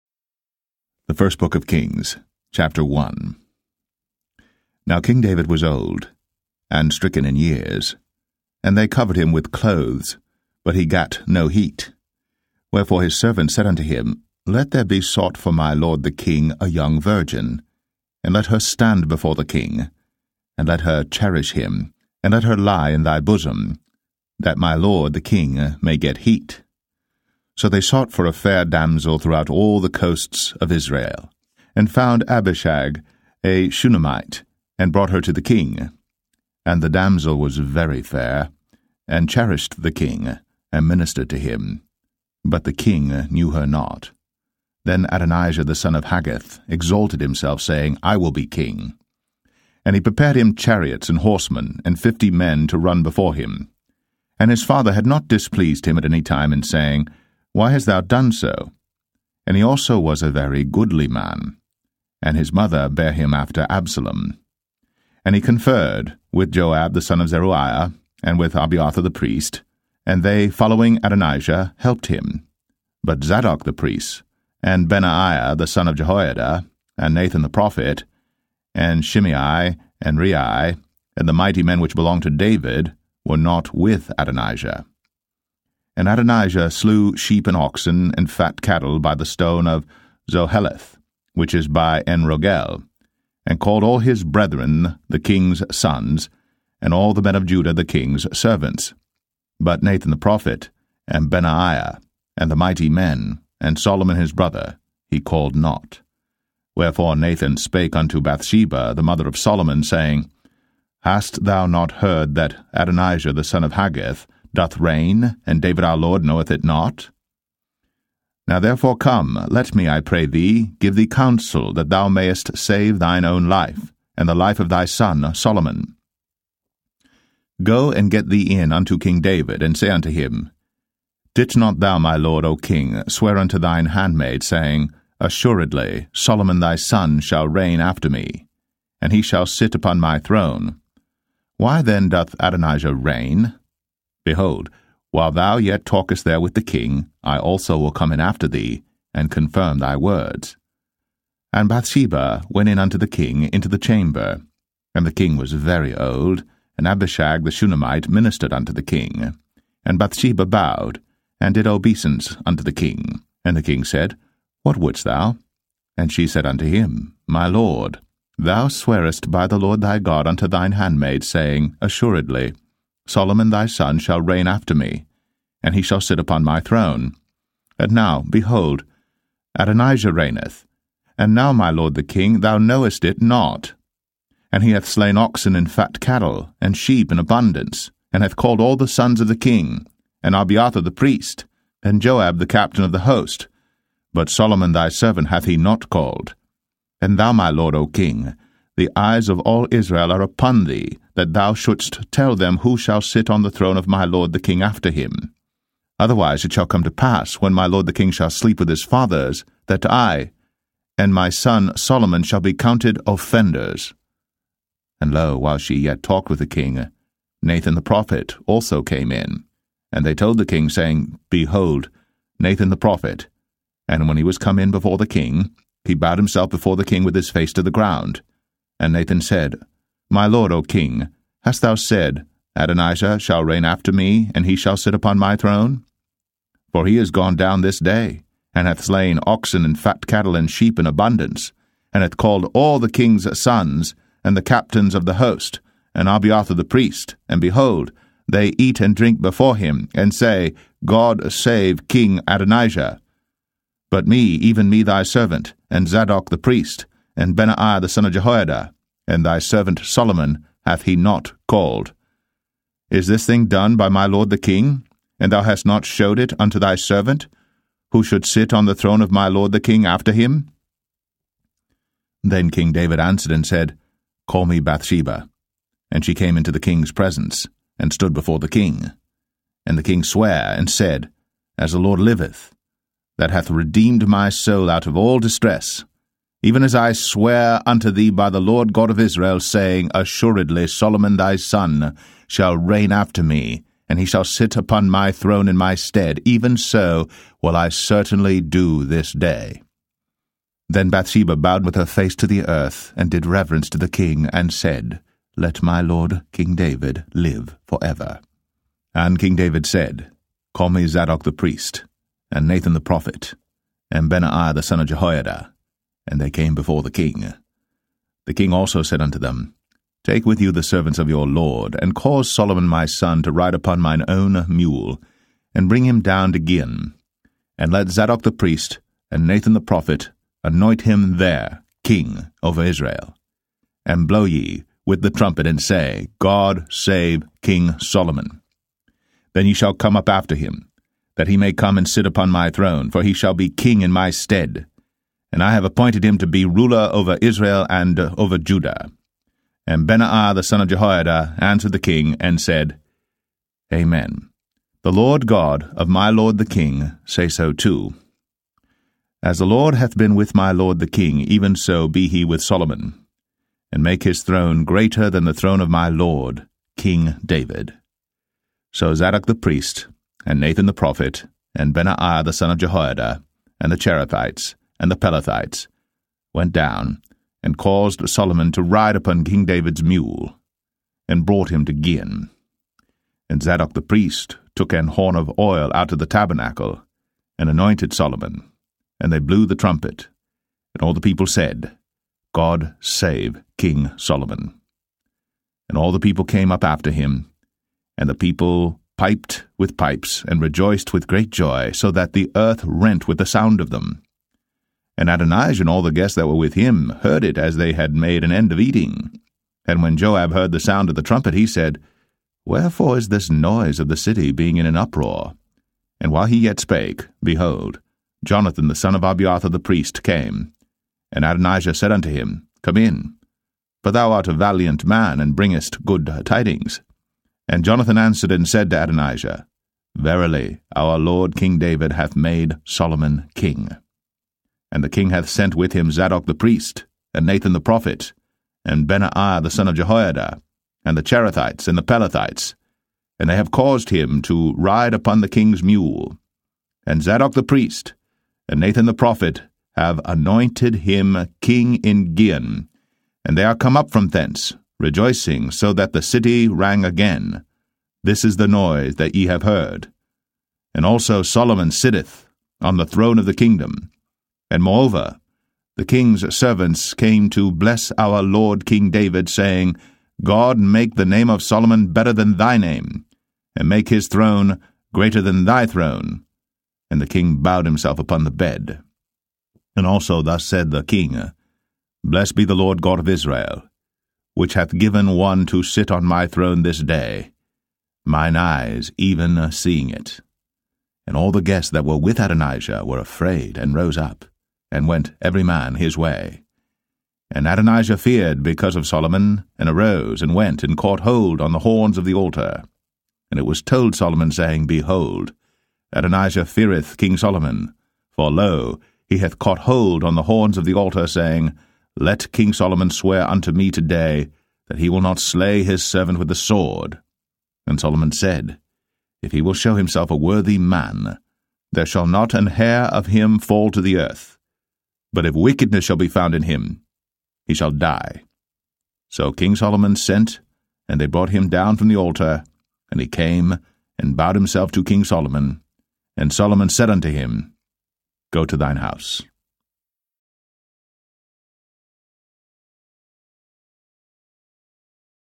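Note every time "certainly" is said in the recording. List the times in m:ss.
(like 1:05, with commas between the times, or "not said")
4:57.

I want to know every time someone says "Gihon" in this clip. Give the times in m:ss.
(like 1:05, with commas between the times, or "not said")
5:26, 6:21, 7:32.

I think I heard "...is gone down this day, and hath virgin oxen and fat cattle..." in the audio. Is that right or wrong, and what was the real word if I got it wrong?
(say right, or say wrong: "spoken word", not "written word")
wrong: "slain", not "virgin".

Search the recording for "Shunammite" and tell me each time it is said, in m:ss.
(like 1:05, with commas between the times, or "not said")
0:33, 2:37.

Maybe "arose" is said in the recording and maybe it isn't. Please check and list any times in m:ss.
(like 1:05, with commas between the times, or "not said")
8:19.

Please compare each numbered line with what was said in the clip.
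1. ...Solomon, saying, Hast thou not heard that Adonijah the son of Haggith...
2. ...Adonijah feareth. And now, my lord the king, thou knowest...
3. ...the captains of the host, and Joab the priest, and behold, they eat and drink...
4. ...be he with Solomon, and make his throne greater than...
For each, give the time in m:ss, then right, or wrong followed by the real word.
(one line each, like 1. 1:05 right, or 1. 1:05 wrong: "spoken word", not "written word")
1. 1:49 right
2. 2:59 wrong: "reigneth", not "feareth"
3. 4:04 wrong: "Abiathar", not "Joab"
4. 6:01 right.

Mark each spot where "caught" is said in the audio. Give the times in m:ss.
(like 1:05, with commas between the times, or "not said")
8:20, 8:29.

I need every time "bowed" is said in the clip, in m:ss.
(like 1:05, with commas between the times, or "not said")
2:40, 3:45, 5:01, 7:57, 8:54.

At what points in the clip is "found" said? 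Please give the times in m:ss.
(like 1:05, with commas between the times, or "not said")
0:31, 8:46.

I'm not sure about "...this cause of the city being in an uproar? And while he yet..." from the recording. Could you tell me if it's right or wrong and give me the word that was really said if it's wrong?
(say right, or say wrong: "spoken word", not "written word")
wrong: "noise", not "cause".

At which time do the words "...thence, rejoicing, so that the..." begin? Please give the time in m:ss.
7:34.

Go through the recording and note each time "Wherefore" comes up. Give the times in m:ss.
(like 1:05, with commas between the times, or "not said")
0:12, 1:46, 6:52.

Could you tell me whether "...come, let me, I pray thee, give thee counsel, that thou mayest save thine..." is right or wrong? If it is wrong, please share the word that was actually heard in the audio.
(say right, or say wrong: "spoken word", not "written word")
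right.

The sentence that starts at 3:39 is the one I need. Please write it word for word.
And they told the king, saying, Behold, Nathan the prophet.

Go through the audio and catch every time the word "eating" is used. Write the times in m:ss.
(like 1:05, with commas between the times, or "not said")
6:48.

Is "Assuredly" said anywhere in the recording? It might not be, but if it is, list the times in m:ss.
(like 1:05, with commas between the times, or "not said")
2:15, 2:51, 4:49.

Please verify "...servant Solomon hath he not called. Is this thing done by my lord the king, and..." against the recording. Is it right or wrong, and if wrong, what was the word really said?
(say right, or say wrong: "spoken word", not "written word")
right.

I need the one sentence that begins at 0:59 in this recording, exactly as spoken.
And he also was a very goodly man, and his mother bare him after Absalom.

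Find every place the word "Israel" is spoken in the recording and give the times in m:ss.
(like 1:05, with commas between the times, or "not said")
0:30, 3:19, 4:48, 5:32, 5:47, 8:03.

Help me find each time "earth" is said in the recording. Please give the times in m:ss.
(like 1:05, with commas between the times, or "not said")
5:02, 6:42, 8:43.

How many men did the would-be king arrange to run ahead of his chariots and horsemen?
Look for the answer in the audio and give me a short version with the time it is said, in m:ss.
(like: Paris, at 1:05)
50, at 0:52.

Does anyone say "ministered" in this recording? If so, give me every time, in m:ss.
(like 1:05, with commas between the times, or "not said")
0:40, 2:38.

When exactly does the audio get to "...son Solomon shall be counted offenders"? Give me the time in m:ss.
3:31.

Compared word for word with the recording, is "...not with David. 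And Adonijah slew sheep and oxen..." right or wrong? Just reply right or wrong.
wrong.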